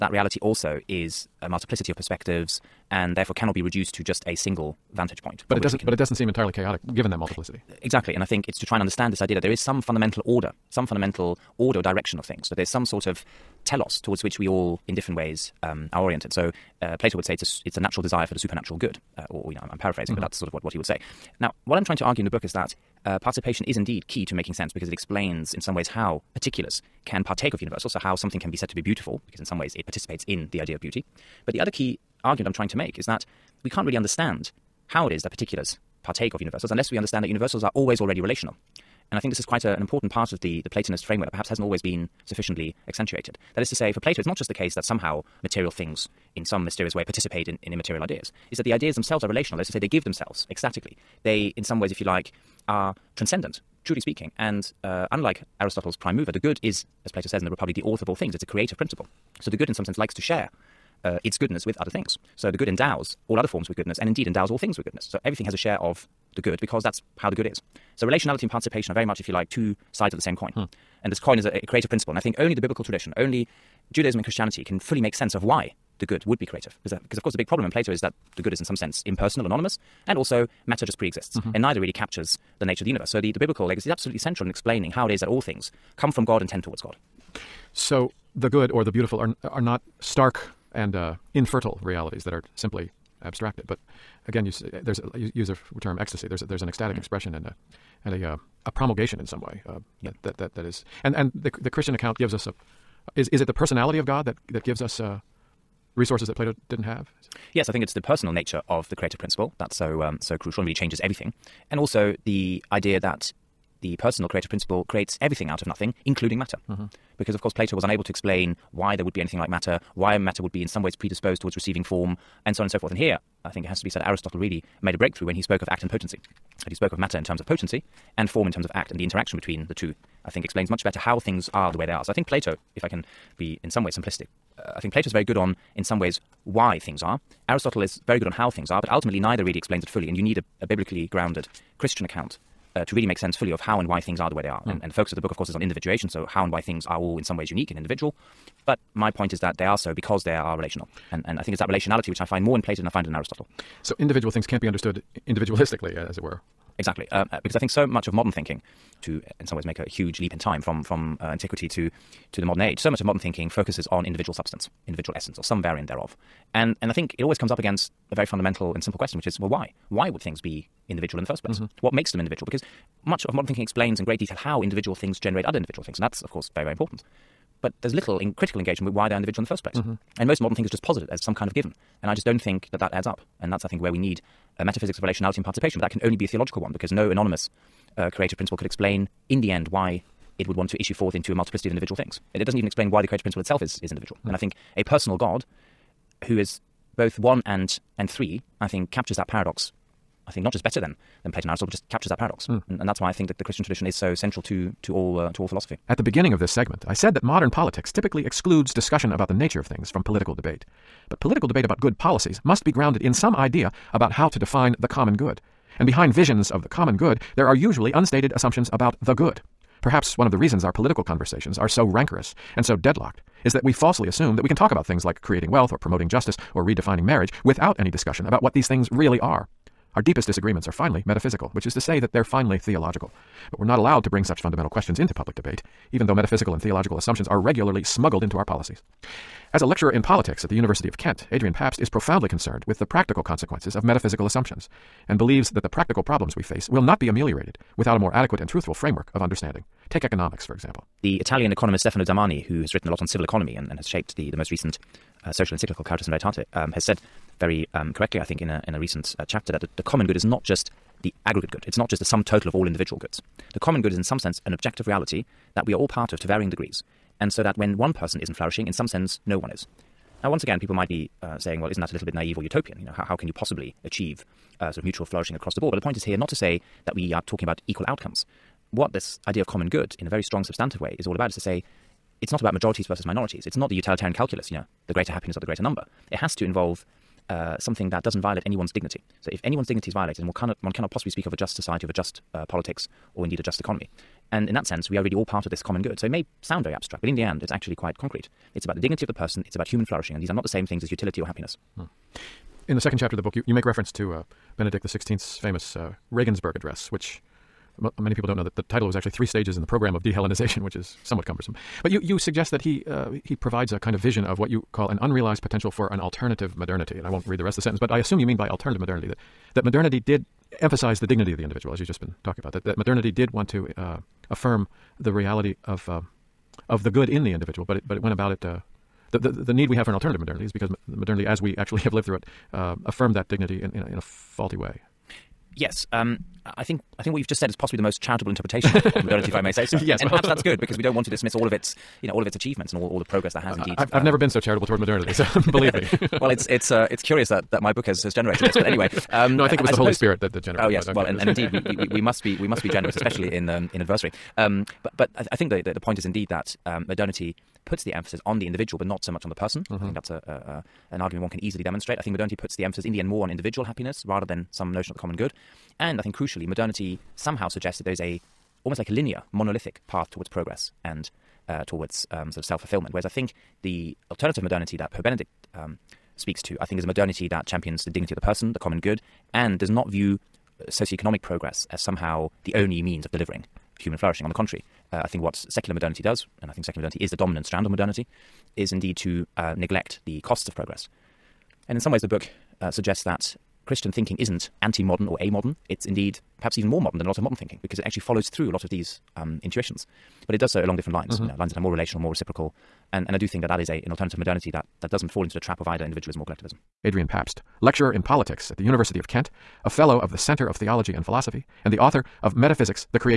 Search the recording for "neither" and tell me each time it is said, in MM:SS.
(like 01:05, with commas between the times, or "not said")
01:21, 02:19.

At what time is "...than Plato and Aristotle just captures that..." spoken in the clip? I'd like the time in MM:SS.
03:21.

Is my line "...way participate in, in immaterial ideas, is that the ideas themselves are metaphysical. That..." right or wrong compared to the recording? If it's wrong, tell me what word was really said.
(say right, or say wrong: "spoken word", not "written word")
wrong: "relational", not "metaphysical".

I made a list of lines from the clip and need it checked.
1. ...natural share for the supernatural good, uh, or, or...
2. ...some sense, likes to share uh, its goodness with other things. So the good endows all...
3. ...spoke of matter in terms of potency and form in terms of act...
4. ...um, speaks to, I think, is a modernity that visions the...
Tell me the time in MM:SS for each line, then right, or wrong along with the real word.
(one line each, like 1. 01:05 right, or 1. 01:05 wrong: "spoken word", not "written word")
1. 00:17 wrong: "desire", not "share"
2. 00:59 right
3. 02:06 right
4. 06:15 wrong: "champions", not "visions".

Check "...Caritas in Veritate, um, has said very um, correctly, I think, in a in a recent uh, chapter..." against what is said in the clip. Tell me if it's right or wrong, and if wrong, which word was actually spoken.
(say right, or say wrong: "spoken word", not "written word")
right.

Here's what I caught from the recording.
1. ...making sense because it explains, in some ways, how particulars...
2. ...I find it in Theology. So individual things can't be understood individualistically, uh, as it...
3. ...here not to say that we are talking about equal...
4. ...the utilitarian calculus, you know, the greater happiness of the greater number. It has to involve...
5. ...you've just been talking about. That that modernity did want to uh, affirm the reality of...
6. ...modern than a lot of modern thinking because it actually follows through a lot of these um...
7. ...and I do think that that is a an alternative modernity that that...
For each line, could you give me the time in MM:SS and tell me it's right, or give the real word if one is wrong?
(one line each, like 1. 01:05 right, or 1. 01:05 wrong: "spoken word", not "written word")
1. 00:24 right
2. 02:32 wrong: "Aristotle", not "Theology"
3. 04:36 right
4. 04:43 right
5. 05:21 right
6. 06:36 right
7. 06:43 right.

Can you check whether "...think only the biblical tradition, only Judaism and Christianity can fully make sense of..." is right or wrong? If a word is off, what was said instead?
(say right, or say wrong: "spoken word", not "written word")
right.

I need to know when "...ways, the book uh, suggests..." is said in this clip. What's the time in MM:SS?
06:31.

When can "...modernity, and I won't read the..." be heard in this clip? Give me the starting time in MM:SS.
05:16.